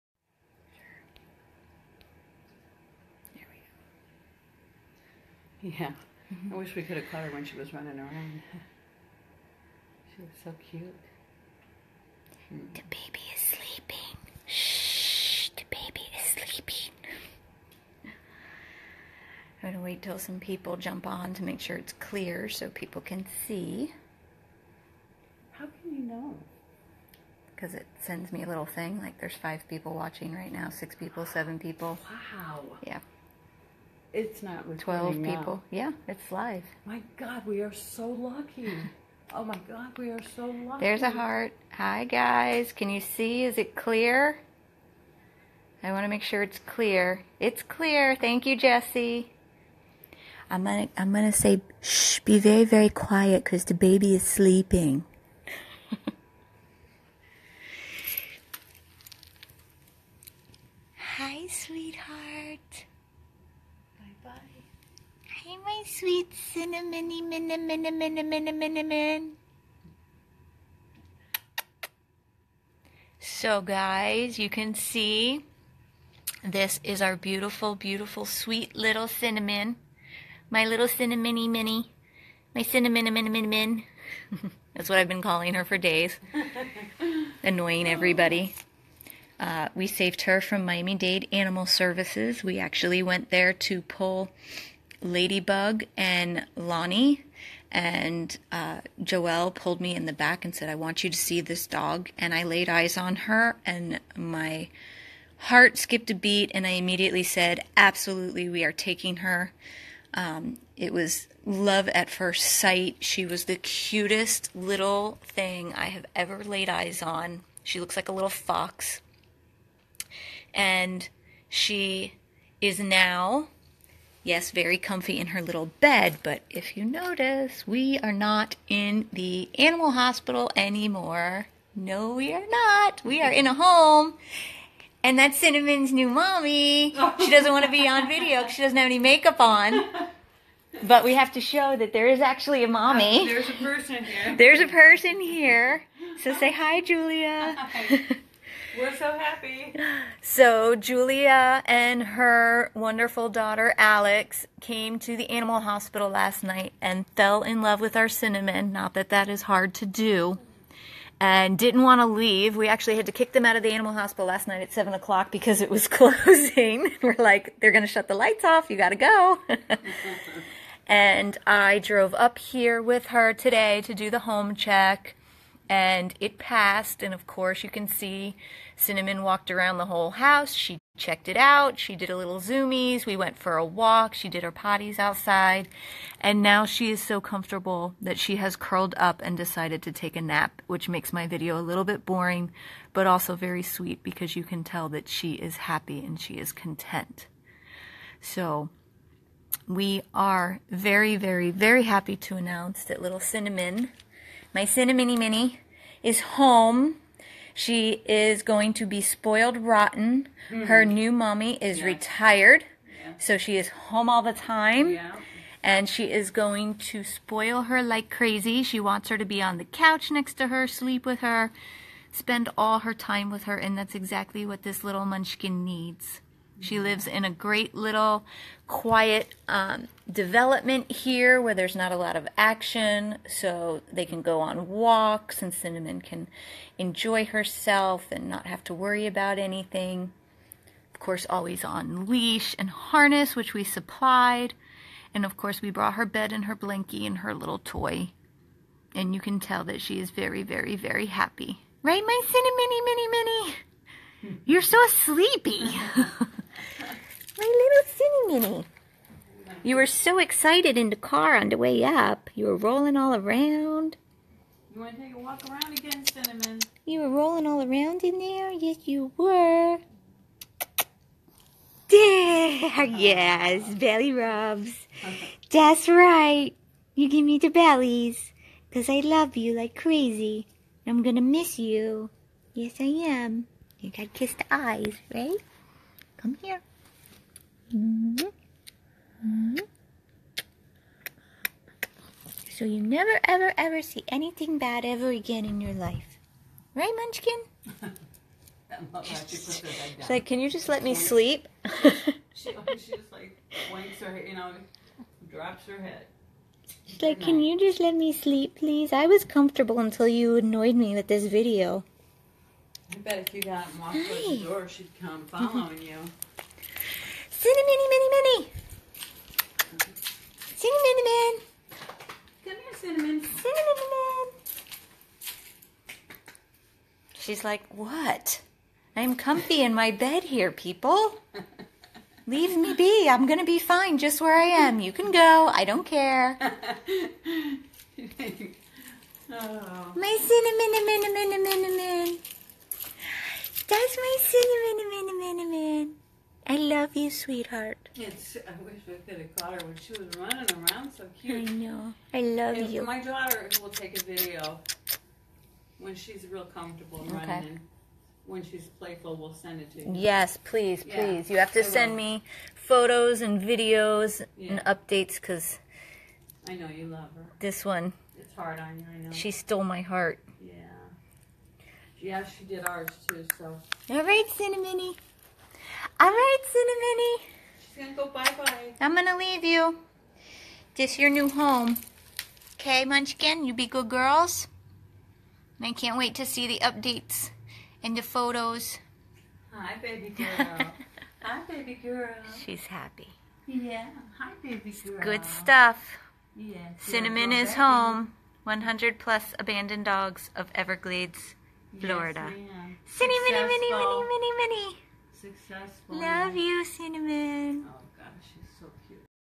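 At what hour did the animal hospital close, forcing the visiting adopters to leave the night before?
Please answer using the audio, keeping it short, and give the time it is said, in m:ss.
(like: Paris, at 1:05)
7 o'clock, at 2:44.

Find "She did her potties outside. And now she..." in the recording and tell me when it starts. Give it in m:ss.
3:04.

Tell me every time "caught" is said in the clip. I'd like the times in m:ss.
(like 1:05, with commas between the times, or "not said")
0:07, 5:49.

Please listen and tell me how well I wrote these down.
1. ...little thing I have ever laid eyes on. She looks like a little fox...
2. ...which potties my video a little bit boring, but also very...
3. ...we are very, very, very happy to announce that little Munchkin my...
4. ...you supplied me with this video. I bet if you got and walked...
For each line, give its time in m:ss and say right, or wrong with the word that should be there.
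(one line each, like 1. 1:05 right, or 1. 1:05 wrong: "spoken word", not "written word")
1. 1:54 right
2. 3:10 wrong: "makes", not "potties"
3. 3:19 wrong: "Cinnamon", not "Munchkin"
4. 5:10 wrong: "annoyed", not "supplied".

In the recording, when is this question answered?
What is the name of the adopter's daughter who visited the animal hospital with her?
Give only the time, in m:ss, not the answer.
2:33.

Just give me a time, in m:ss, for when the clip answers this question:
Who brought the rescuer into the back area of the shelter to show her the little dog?
1:39.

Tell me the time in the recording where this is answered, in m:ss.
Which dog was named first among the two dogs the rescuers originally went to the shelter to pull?
1:35.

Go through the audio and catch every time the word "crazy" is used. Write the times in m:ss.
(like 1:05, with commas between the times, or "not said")
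3:38, 4:39.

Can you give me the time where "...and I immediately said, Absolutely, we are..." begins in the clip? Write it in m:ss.
1:46.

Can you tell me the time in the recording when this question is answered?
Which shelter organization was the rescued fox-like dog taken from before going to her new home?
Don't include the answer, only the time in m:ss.
1:30.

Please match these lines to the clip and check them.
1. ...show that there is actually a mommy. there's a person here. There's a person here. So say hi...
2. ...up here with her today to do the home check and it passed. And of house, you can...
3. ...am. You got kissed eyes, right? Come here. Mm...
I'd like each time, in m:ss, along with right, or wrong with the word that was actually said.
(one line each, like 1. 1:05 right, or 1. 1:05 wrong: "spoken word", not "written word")
1. 2:21 right
2. 2:52 wrong: "course", not "house"
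3. 4:43 right.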